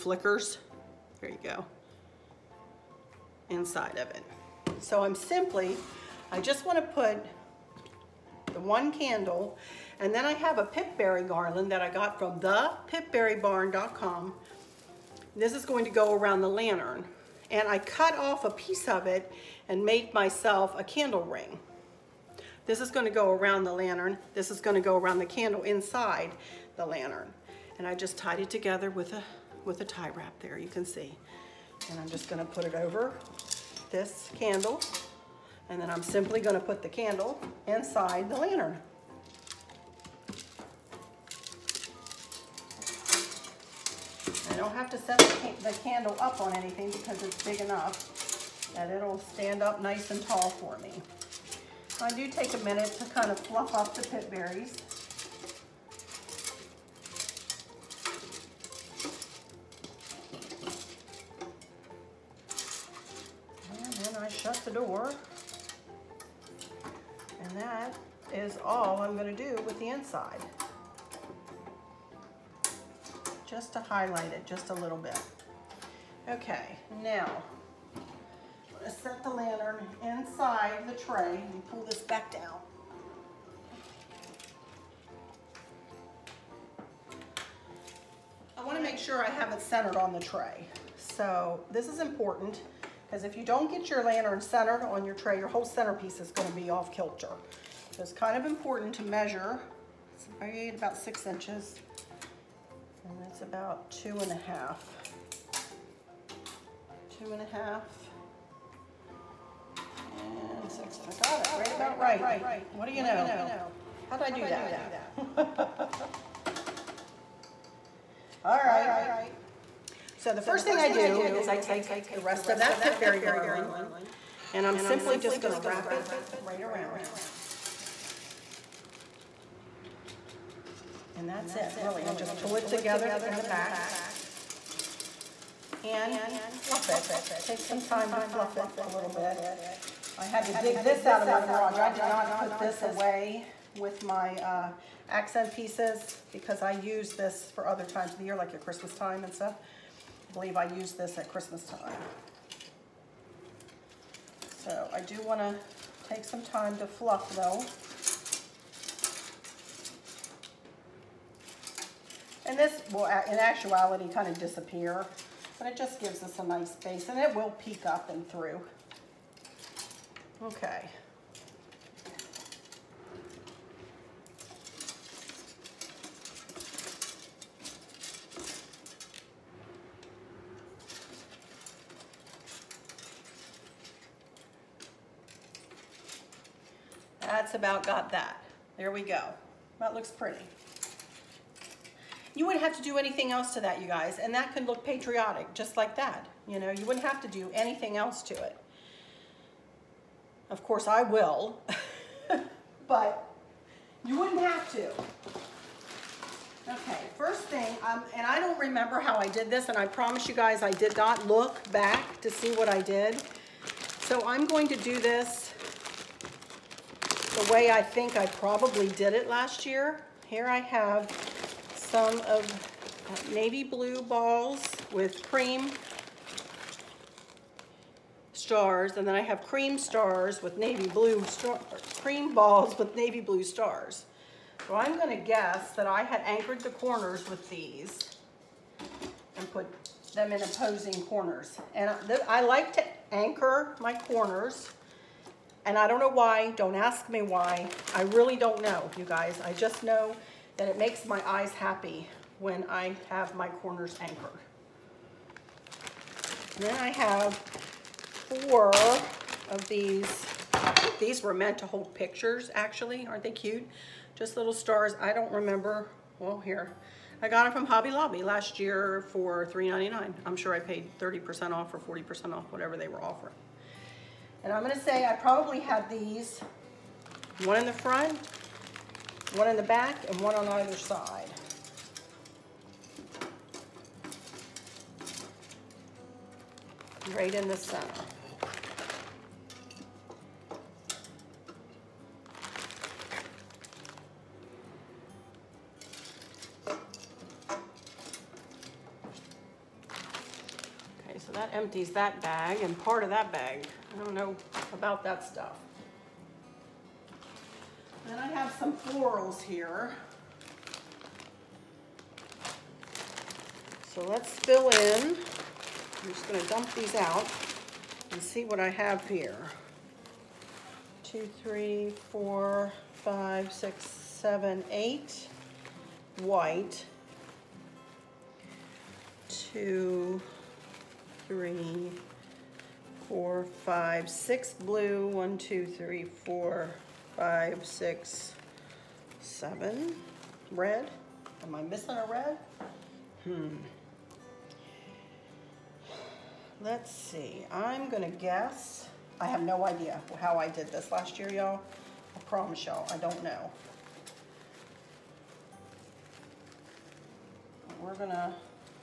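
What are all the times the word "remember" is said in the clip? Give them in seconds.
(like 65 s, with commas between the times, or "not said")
208 s, 265 s.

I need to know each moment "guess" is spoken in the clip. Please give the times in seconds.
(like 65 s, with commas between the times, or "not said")
235 s, 348 s.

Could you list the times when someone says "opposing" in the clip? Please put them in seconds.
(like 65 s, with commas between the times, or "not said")
240 s.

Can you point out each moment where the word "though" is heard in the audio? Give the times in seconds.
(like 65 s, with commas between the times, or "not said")
157 s.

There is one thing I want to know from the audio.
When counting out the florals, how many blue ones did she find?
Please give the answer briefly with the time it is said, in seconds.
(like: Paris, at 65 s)
6, at 334 s.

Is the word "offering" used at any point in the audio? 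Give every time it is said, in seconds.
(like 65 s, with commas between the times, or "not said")
273 s.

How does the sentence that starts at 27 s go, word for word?
And I just tied it together with a, with a tie wrap there, you can see.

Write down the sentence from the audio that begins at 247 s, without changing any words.
I really don't know, you guys.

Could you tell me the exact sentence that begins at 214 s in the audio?
So I'm going to do this the way I think I probably did it last year.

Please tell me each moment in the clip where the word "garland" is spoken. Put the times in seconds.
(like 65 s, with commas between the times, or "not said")
11 s, 123 s.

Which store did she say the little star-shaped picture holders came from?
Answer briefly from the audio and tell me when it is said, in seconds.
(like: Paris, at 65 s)
Hobby Lobby, at 267 s.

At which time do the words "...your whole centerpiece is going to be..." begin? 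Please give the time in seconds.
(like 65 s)
95 s.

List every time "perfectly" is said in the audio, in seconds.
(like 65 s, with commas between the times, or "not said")
not said.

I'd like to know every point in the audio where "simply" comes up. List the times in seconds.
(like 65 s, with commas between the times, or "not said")
5 s, 36 s, 124 s.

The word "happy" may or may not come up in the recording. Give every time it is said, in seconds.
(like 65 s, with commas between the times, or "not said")
251 s.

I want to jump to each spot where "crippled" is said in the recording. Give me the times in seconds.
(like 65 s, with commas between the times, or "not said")
not said.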